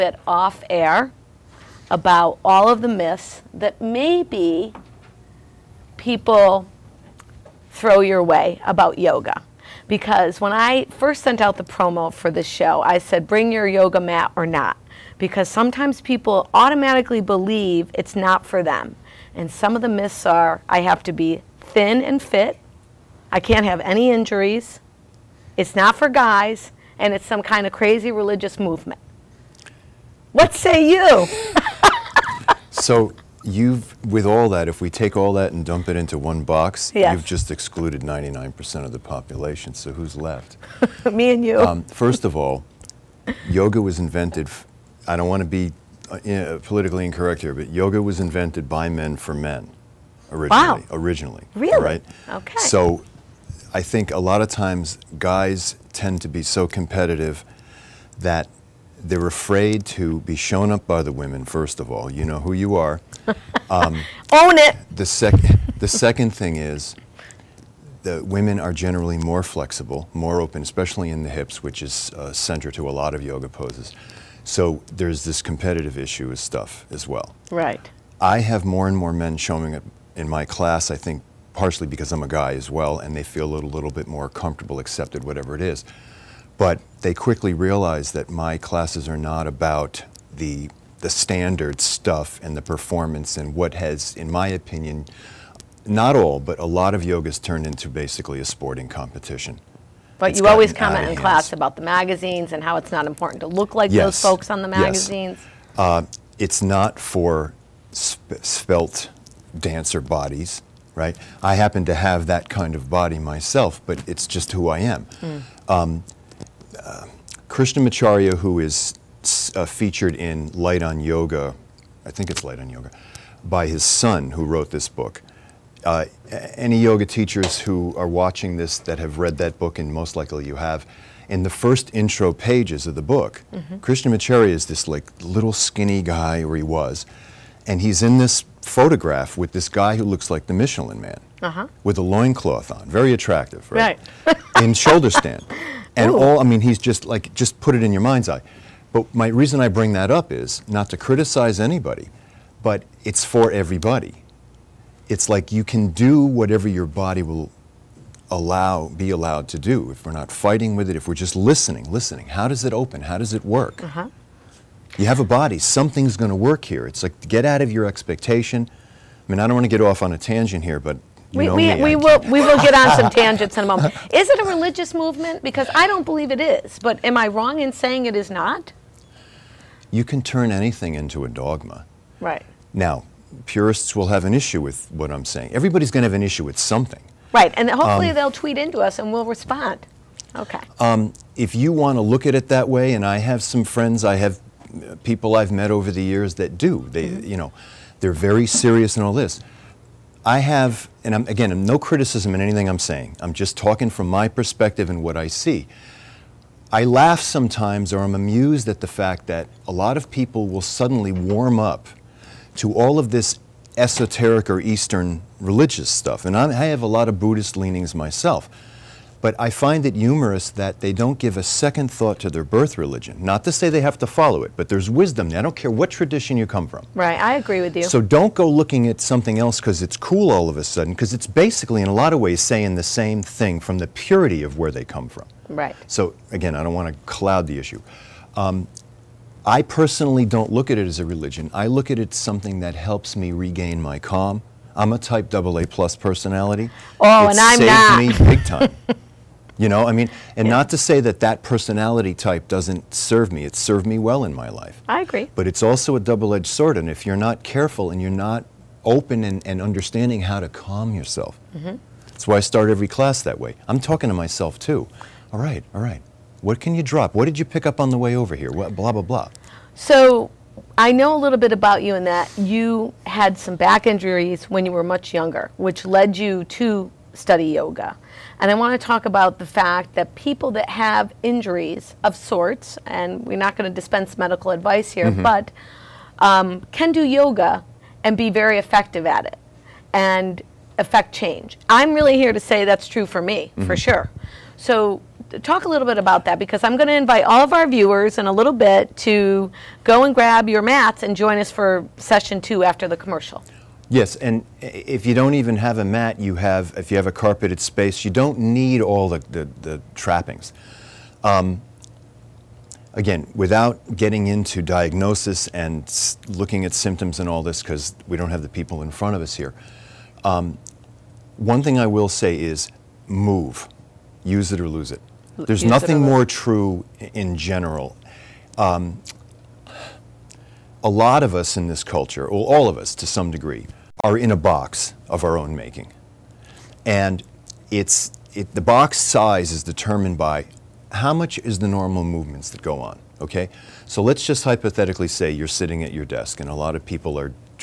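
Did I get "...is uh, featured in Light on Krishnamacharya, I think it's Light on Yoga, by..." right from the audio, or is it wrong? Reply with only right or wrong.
wrong.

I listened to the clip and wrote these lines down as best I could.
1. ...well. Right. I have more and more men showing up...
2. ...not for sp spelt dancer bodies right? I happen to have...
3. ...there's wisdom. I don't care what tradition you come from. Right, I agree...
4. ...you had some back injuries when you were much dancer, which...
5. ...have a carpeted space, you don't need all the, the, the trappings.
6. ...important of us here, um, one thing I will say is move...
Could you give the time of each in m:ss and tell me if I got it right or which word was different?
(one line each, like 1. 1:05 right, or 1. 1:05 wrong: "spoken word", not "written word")
1. 1:17 right
2. 1:46 right
3. 3:44 right
4. 4:32 wrong: "younger", not "dancer"
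5. 5:06 right
6. 5:18 wrong: "front", not "important".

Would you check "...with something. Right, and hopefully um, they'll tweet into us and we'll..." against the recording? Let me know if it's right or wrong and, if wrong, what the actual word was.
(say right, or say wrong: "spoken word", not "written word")
right.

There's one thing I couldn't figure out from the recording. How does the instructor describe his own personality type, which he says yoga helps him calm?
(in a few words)
Type AA plus.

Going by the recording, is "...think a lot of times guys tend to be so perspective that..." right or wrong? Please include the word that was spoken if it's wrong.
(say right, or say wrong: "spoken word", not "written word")
wrong: "competitive", not "perspective".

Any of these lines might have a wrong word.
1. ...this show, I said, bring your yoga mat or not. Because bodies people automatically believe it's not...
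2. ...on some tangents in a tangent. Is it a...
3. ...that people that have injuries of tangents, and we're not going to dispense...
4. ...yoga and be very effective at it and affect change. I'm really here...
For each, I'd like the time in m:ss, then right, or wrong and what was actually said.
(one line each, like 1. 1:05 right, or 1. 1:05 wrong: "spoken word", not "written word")
1. 0:12 wrong: "sometimes", not "bodies"
2. 2:52 wrong: "moment", not "tangent"
3. 4:39 wrong: "sorts", not "tangents"
4. 4:47 right.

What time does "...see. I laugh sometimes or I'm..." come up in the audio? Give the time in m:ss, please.
3:25.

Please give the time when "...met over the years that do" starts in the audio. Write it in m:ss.
3:15.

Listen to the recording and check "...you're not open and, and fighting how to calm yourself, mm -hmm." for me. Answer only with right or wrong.
wrong.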